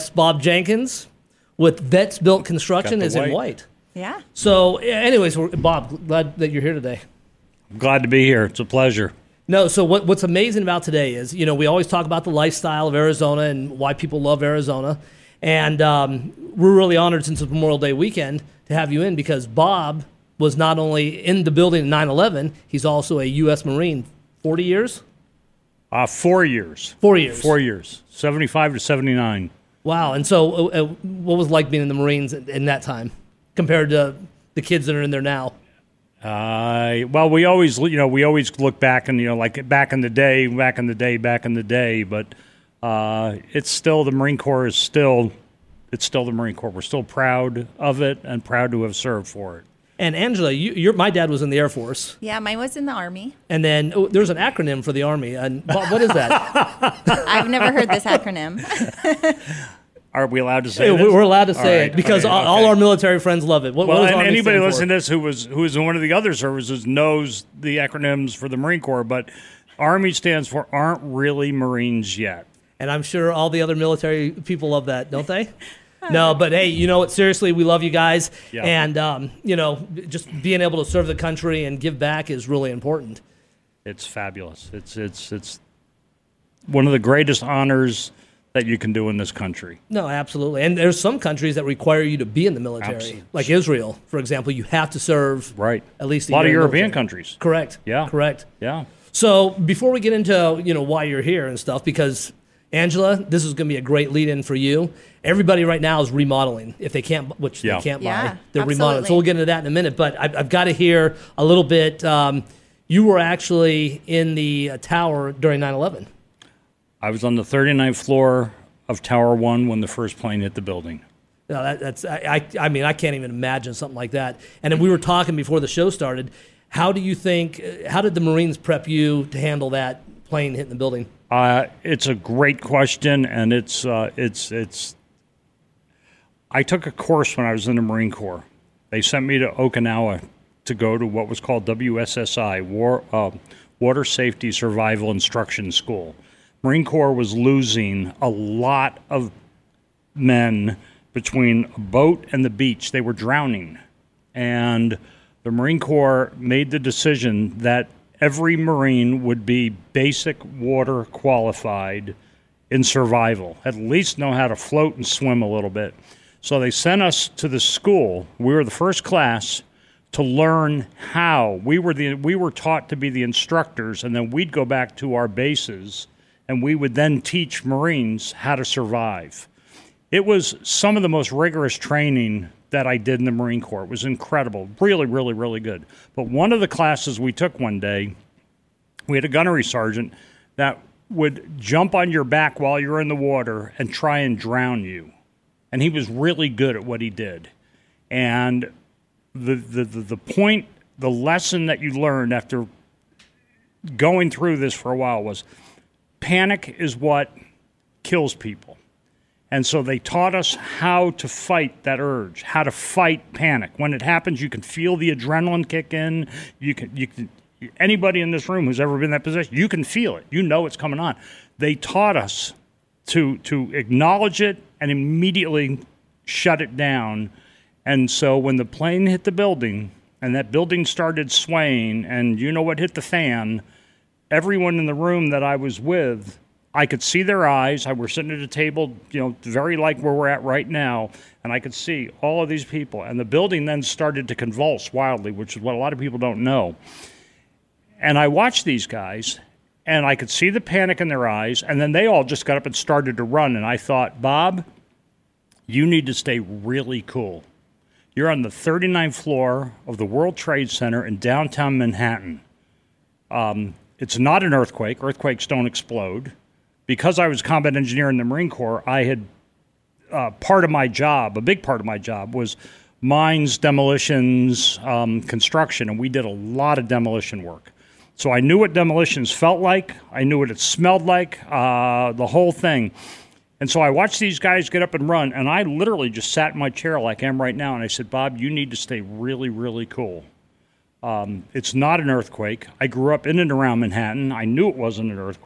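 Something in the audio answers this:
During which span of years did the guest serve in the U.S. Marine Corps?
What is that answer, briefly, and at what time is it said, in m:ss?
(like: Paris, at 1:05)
1975 to 1979, at 0:28.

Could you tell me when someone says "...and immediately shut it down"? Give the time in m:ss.
3:44.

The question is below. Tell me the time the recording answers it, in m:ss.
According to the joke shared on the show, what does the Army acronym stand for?
1:10.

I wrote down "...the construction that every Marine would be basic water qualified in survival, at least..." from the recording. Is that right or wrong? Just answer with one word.
wrong.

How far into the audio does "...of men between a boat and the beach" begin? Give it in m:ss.
2:29.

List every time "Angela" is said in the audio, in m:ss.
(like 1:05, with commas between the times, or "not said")
0:50, 1:42.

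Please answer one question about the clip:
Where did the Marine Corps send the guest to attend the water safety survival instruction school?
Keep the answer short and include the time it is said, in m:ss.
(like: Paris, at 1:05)
Okinawa, at 2:19.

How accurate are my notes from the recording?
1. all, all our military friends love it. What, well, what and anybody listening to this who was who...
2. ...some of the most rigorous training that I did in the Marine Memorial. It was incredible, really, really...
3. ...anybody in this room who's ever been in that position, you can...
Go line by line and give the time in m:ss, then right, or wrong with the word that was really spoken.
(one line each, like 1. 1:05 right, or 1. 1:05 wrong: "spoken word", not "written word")
1. 1:02 right
2. 3:00 wrong: "Corps", not "Memorial"
3. 3:37 right.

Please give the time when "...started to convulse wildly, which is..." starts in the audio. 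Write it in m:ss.
4:03.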